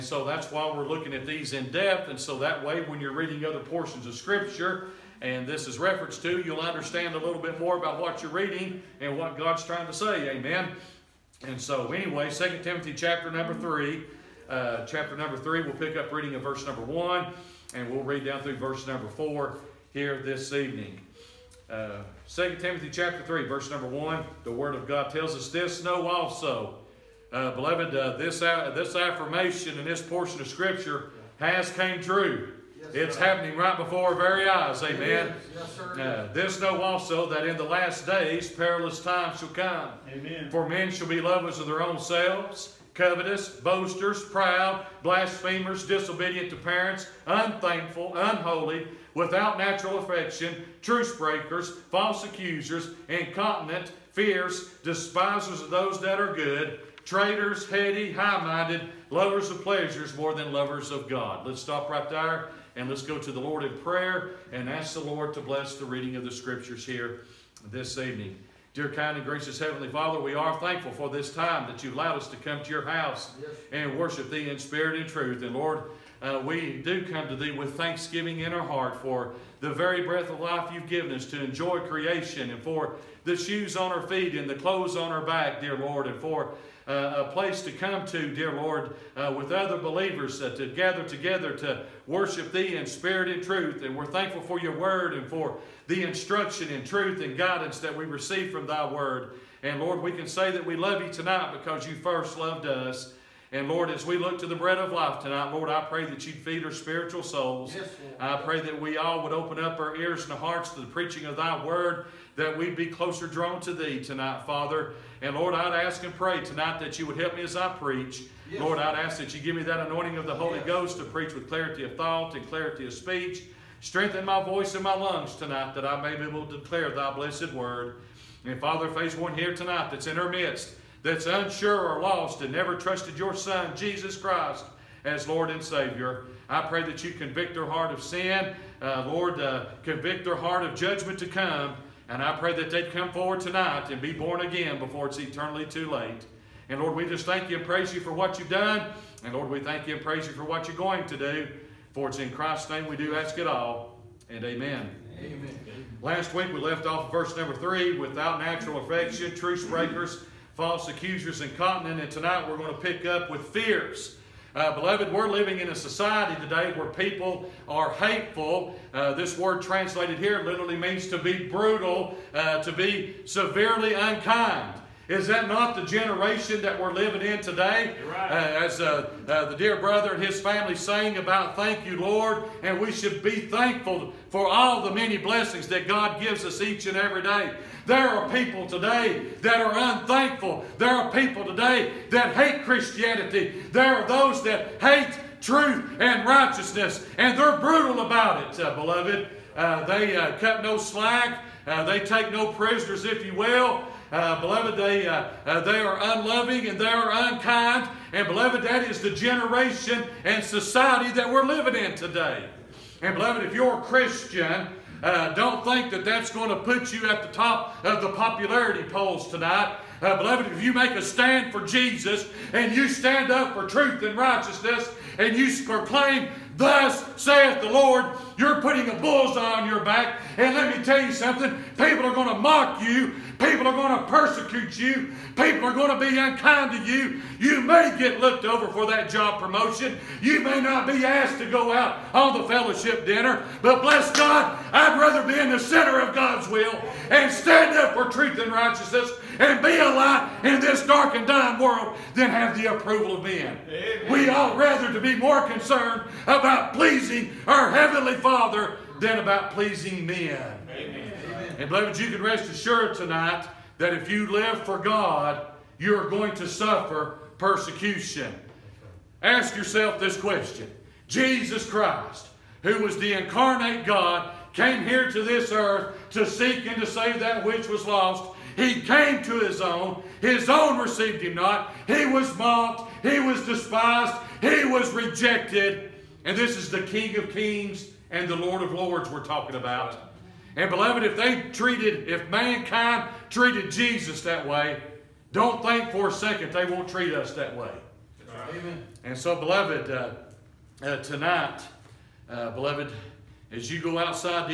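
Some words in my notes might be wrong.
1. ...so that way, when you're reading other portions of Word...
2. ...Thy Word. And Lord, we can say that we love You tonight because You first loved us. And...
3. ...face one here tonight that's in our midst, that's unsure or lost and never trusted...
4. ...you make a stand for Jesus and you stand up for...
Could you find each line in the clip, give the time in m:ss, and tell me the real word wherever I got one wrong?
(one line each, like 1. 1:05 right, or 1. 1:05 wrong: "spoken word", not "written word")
1. 0:02 wrong: "Scripture", not "Word"
2. 1:38 right
3. 2:08 right
4. 3:40 right.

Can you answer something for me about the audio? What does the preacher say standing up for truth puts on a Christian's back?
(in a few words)
A bullseye.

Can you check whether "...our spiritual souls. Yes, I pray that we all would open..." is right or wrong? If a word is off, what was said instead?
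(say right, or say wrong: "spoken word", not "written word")
right.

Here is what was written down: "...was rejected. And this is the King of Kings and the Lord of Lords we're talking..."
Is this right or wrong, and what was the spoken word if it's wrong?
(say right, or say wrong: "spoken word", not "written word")
right.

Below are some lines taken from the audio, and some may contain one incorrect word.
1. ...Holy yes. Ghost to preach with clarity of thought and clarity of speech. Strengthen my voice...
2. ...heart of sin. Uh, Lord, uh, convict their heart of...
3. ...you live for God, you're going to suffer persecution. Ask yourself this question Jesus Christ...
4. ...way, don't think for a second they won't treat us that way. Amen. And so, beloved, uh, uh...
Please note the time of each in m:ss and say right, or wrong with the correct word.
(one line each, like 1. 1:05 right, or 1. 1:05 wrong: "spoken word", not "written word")
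1. 2:00 right
2. 2:17 right
3. 4:24 right
4. 4:54 right.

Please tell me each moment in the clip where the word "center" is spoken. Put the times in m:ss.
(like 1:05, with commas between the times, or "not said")
4:05.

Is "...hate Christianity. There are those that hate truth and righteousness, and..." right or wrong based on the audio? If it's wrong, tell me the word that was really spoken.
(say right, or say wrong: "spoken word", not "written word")
right.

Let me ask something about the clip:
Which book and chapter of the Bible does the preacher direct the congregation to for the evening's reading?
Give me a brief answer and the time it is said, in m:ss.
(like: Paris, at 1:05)
2 Timothy chapter 3, at 0:12.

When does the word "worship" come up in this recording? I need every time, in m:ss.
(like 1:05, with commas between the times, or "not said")
1:13, 1:32.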